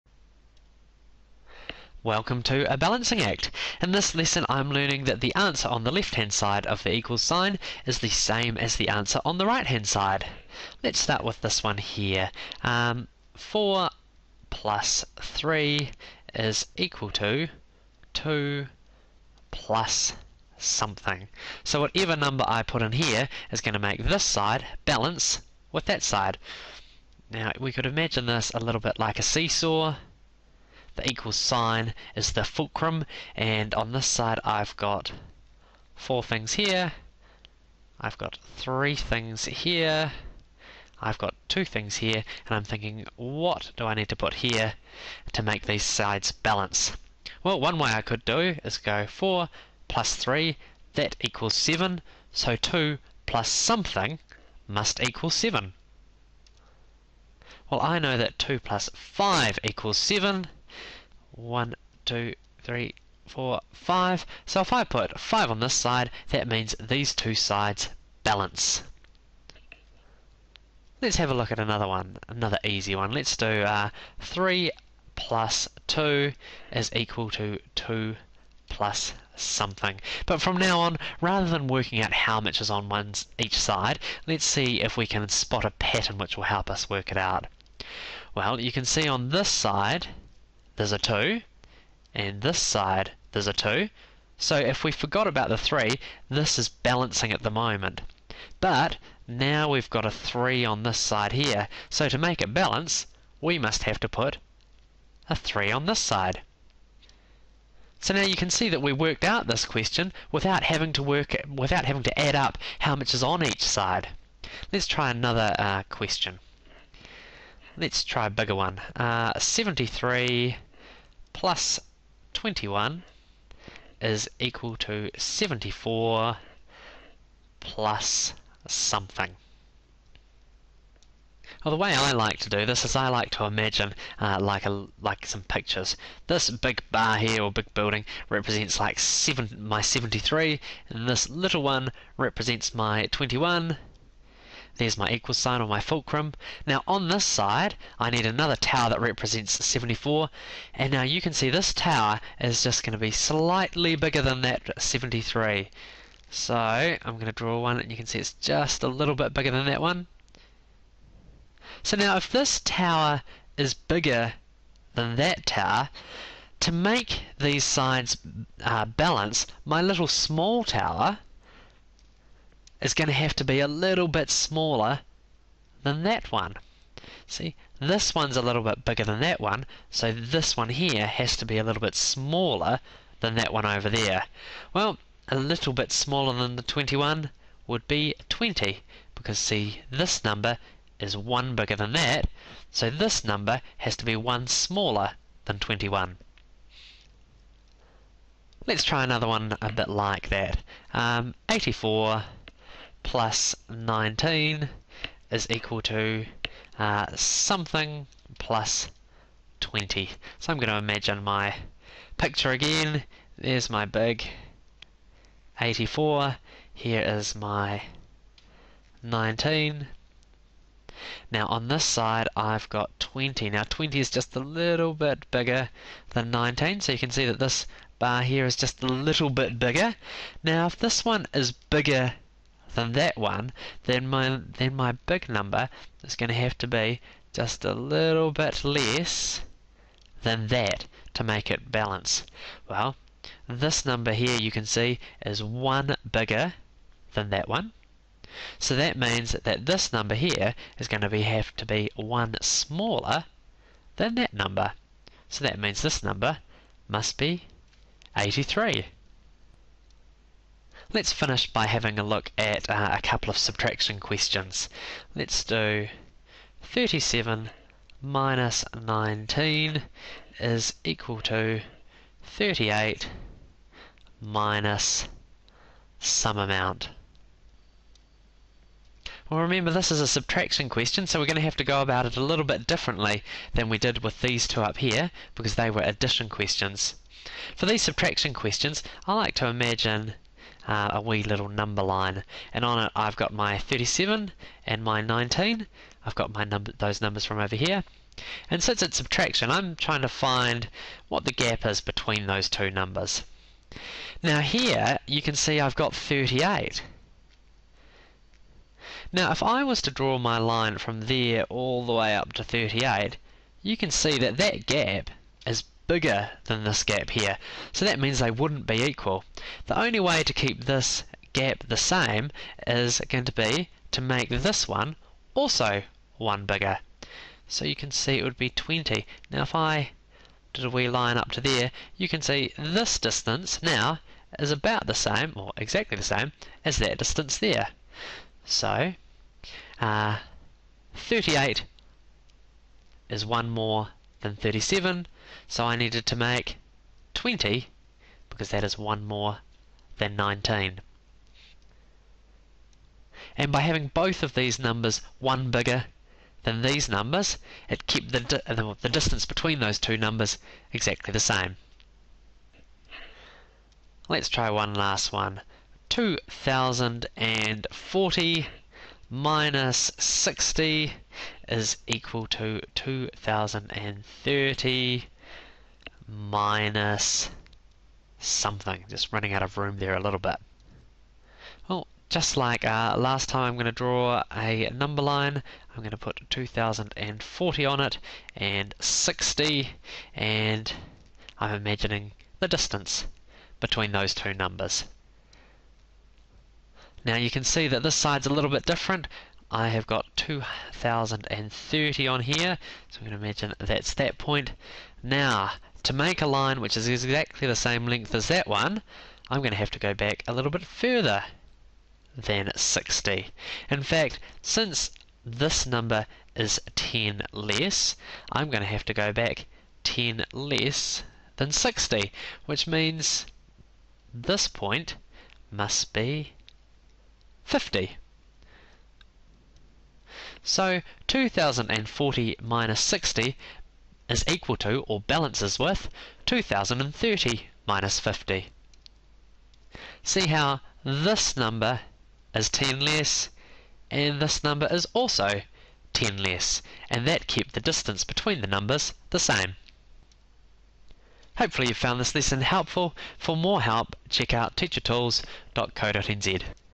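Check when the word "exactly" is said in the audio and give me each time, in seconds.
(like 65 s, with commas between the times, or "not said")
335 s, 360 s, 406 s.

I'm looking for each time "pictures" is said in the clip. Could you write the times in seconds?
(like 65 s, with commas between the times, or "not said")
135 s, 212 s.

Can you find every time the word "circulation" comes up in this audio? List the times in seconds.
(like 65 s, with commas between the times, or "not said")
not said.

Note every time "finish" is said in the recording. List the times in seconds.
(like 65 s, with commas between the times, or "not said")
261 s.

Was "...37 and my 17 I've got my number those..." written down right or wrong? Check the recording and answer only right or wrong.
wrong.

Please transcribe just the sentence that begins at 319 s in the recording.
The only way to keep this gap the same is going to be to make this one also 1 bigger.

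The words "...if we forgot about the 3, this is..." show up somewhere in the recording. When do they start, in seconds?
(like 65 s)
94 s.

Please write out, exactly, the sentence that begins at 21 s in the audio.
So whatever number I put in here is going to make this side balance with that side.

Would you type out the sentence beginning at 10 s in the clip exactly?
Let's start with this one here.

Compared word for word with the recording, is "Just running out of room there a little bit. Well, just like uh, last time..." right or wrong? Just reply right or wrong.
right.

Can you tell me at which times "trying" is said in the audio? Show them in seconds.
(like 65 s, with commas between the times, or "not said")
299 s.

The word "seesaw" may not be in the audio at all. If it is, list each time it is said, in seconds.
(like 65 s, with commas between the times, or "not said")
29 s.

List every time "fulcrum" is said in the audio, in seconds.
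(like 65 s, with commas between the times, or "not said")
32 s, 145 s.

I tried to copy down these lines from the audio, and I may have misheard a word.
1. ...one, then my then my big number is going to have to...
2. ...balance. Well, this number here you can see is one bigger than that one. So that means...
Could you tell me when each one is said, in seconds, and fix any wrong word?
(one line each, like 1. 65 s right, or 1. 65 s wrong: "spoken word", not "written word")
1. 233 s right
2. 241 s right.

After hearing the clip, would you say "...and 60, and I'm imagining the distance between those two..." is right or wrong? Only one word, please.
right.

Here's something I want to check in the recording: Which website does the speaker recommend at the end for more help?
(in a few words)
teachertools.co.nz.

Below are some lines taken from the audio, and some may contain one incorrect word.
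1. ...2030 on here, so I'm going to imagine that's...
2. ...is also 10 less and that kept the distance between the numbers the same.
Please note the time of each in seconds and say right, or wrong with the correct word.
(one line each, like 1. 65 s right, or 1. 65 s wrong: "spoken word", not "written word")
1. 400 s right
2. 444 s right.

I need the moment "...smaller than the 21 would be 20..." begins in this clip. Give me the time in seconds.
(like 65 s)
185 s.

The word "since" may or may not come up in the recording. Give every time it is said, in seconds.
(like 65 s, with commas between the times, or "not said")
298 s, 414 s.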